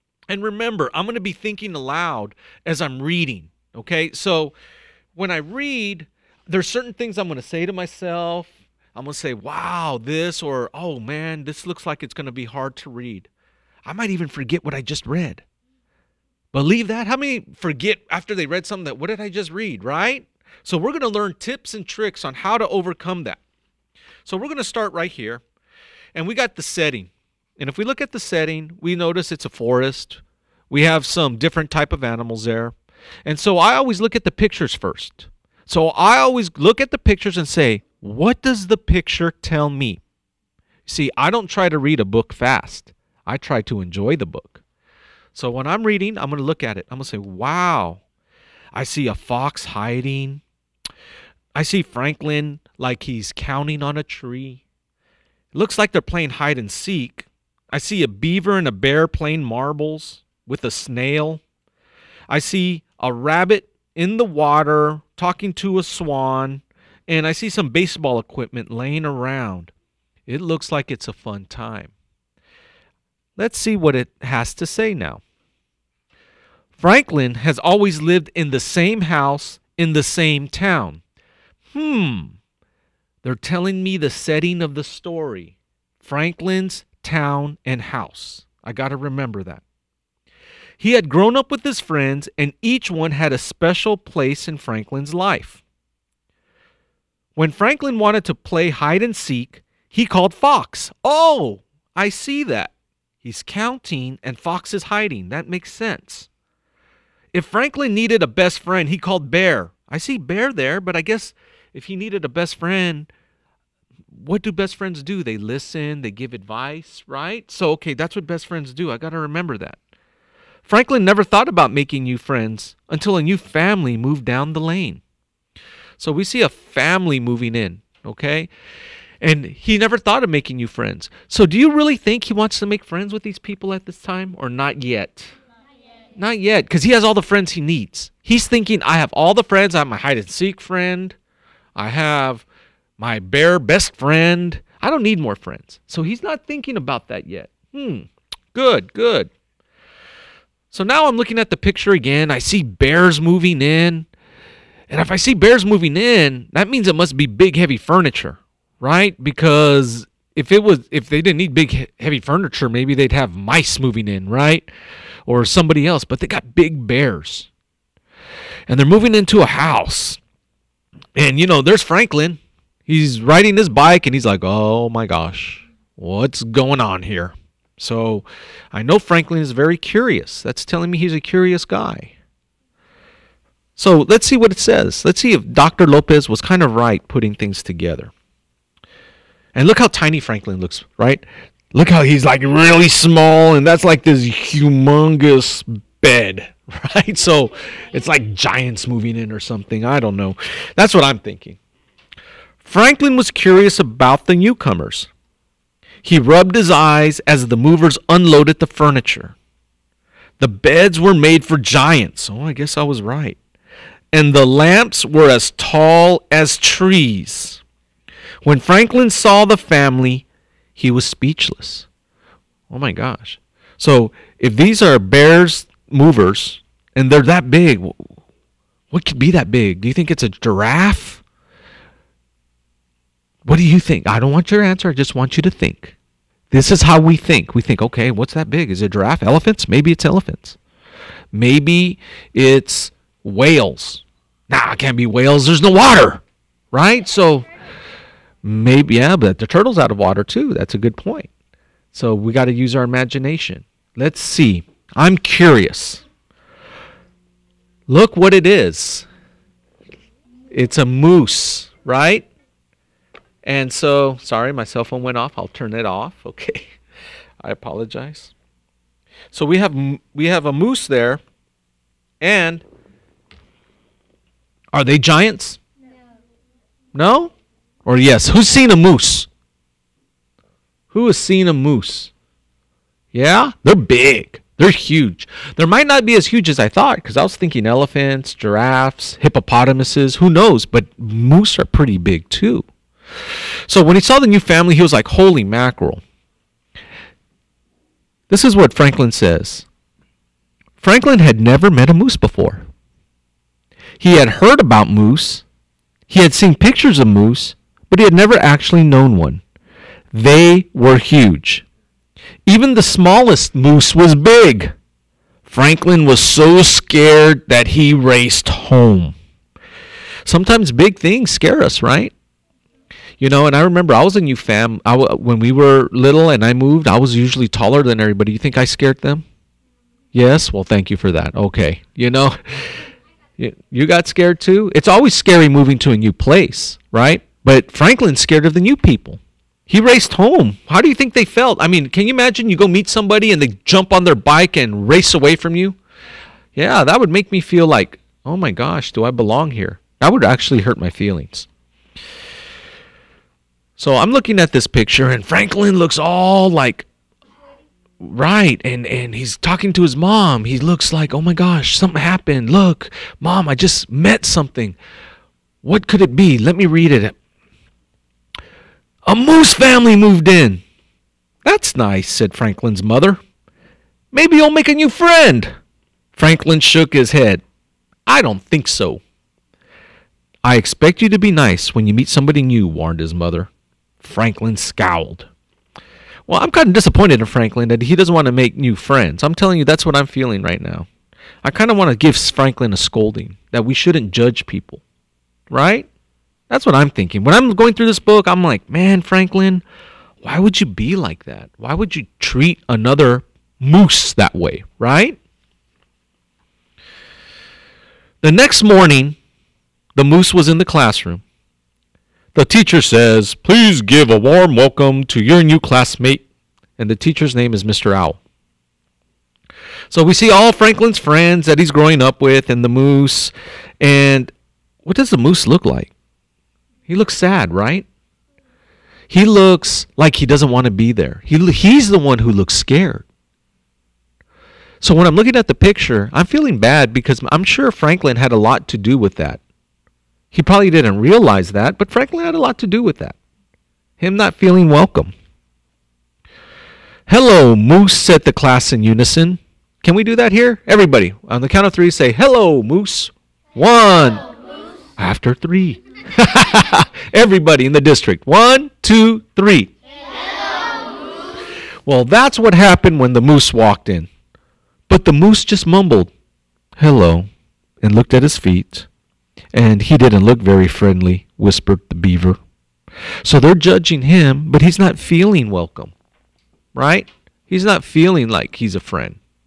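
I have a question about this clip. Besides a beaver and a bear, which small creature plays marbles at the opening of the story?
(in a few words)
a snail.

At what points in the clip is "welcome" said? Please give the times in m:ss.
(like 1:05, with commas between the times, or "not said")
6:54, 7:24, 7:55.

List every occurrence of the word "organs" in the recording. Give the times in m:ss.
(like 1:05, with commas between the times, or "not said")
not said.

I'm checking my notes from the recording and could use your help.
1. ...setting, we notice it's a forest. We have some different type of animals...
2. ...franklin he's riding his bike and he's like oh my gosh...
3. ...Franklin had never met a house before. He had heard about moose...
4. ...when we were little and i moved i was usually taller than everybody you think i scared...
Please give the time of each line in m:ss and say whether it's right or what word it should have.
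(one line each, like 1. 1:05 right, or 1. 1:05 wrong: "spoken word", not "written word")
1. 0:28 right
2. 2:51 right
3. 5:00 wrong: "moose", not "house"
4. 5:25 right.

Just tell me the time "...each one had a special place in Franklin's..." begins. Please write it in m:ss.
1:32.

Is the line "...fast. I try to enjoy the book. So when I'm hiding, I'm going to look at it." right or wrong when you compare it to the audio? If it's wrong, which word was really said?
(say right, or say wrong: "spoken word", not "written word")
wrong: "reading", not "hiding".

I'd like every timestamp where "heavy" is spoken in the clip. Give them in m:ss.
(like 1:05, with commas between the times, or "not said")
2:37, 2:41.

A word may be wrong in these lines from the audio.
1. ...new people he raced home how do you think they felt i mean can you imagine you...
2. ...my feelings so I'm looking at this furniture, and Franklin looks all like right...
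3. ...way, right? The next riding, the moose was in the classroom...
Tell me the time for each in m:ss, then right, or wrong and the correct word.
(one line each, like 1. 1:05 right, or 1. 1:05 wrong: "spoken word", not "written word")
1. 5:38 right
2. 5:50 wrong: "picture", not "furniture"
3. 6:44 wrong: "morning", not "riding".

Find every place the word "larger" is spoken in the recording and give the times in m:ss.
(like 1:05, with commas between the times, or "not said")
not said.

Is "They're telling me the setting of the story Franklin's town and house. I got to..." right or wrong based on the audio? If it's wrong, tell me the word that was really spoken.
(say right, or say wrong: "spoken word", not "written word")
right.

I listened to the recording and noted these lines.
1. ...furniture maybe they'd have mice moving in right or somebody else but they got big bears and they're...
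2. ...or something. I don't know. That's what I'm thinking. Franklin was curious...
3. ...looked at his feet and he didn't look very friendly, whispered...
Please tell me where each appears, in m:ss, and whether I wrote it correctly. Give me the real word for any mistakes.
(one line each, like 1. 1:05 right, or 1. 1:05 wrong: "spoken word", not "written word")
1. 2:42 right
2. 3:19 right
3. 7:47 right.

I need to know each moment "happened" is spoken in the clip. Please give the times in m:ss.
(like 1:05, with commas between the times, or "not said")
6:02, 7:42.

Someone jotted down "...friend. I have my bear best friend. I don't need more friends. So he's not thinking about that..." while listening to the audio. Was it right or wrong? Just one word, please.
right.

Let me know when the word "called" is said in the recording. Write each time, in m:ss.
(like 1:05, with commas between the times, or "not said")
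1:40, 1:48.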